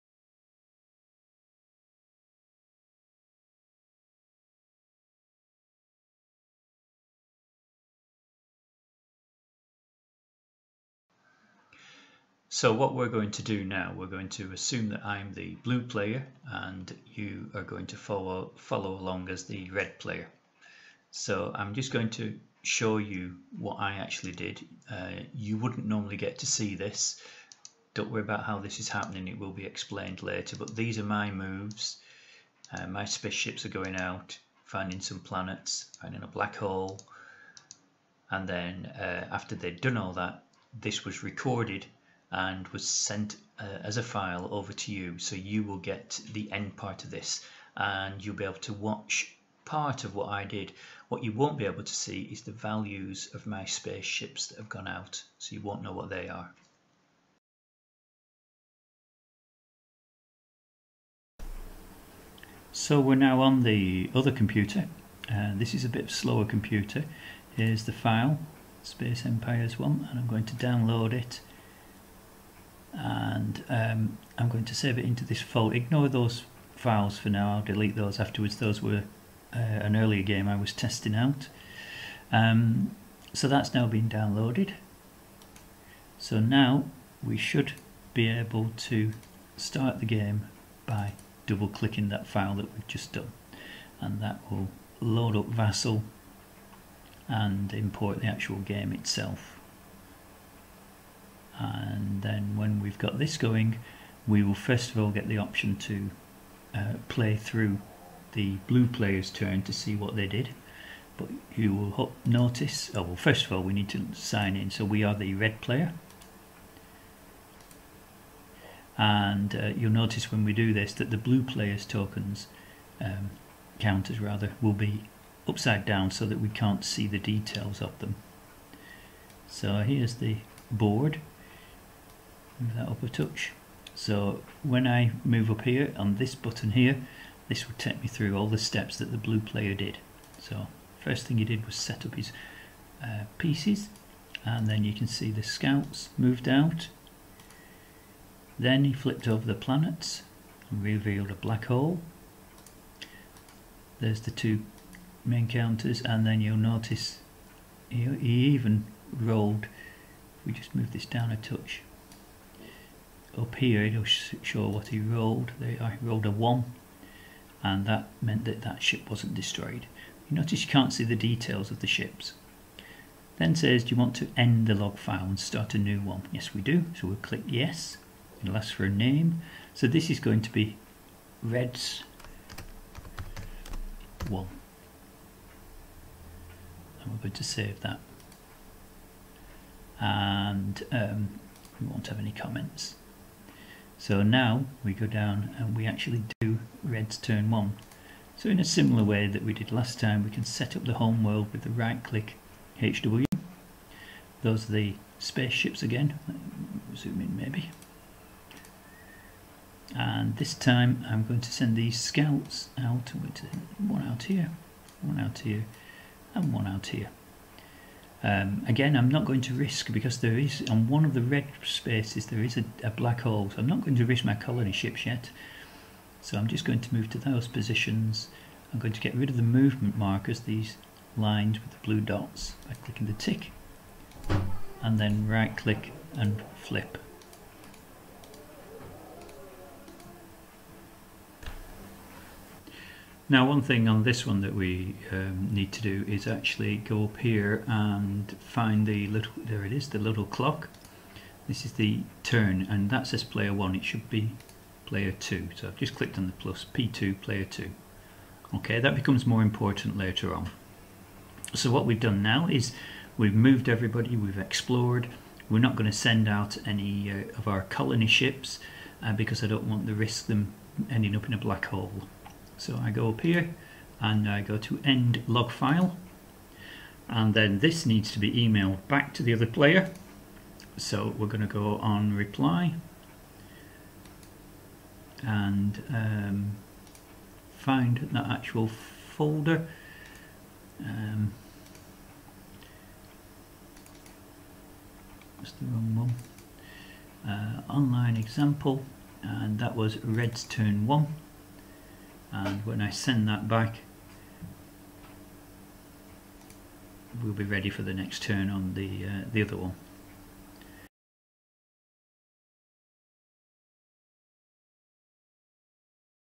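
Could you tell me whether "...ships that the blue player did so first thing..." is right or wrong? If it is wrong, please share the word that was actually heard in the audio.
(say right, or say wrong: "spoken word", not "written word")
wrong: "steps", not "ships".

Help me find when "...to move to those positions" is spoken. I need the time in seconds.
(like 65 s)
226 s.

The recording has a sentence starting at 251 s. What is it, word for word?
This is the turn and that says player 1, it should be player 2.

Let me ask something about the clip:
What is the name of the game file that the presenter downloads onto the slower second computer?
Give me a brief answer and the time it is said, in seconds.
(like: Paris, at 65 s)
Space Empires 1, at 68 s.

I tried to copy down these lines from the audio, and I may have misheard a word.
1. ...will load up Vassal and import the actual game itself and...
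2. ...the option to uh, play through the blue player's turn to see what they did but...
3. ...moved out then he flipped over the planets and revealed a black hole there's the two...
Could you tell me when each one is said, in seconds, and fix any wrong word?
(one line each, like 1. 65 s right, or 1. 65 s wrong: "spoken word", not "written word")
1. 94 s right
2. 105 s right
3. 146 s right.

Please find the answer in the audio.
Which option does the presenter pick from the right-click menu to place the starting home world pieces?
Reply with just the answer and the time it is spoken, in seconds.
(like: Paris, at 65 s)
HW, at 202 s.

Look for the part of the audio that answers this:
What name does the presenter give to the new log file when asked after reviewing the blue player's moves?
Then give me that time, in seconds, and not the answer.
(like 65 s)
181 s.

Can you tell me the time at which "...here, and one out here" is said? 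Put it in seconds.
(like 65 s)
215 s.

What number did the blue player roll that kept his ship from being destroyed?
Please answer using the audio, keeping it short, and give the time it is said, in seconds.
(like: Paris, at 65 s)
1, at 165 s.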